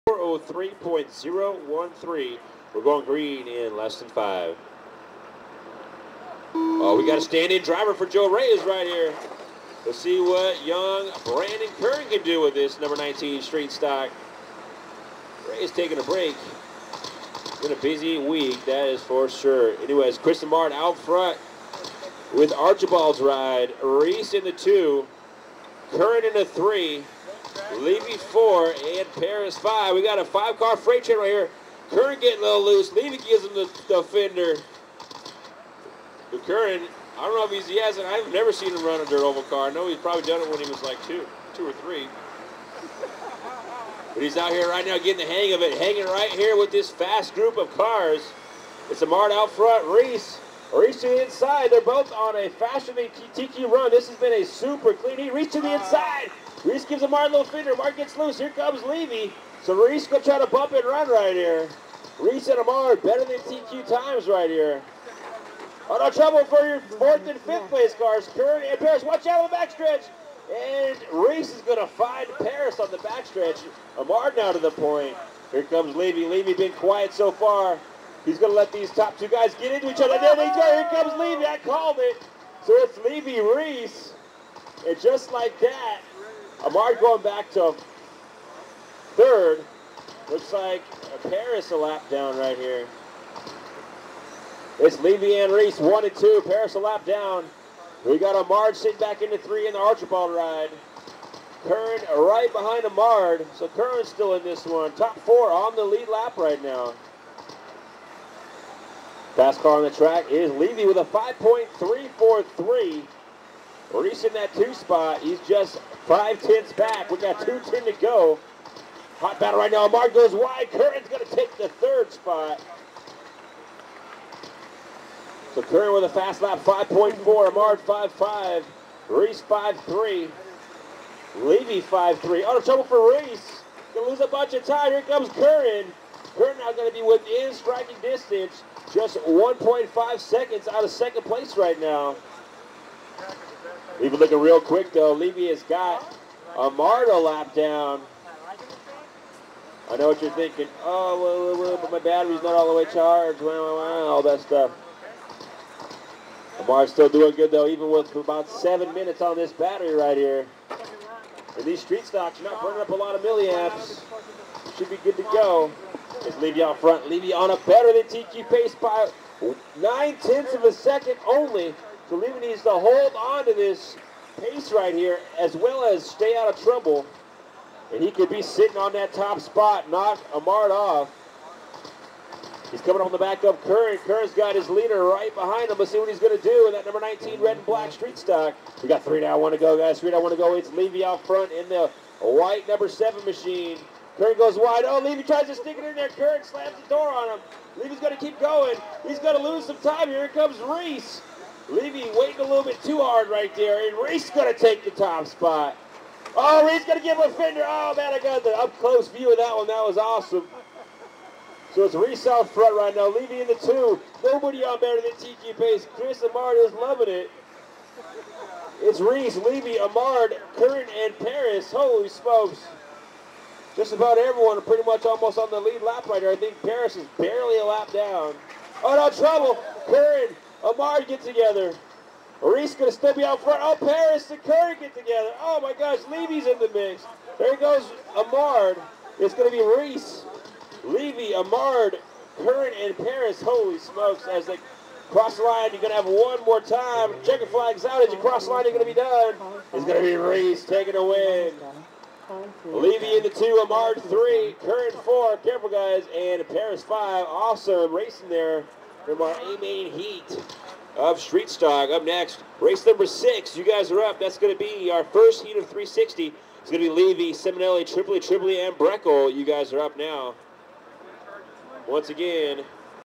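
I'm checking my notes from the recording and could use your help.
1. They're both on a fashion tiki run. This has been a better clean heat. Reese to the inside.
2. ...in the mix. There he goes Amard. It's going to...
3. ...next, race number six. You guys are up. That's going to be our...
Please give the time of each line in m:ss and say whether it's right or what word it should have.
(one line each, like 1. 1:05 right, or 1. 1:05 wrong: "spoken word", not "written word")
1. 0:51 wrong: "super", not "better"
2. 3:56 right
3. 4:22 right.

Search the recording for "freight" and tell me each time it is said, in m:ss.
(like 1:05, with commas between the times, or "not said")
0:30.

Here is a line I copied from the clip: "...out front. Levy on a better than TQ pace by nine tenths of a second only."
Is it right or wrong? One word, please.
right.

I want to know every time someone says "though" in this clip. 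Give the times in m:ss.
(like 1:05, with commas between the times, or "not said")
2:24, 2:37.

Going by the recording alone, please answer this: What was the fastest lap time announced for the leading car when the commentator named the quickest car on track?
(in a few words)
5.343.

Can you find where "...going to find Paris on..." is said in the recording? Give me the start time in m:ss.
1:11.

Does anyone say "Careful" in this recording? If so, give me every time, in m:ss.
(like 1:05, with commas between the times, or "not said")
4:15.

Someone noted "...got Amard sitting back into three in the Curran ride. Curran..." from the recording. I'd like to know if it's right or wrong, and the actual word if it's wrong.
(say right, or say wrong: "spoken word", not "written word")
wrong: "Archibald", not "Curran".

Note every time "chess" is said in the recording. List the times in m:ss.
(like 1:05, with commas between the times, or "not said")
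not said.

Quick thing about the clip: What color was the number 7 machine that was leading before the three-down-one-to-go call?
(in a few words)
white.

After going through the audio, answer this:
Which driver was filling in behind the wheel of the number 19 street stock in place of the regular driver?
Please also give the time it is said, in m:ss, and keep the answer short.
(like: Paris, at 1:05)
Brandon Curran, at 0:11.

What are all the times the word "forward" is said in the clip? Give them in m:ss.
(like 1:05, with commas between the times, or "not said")
not said.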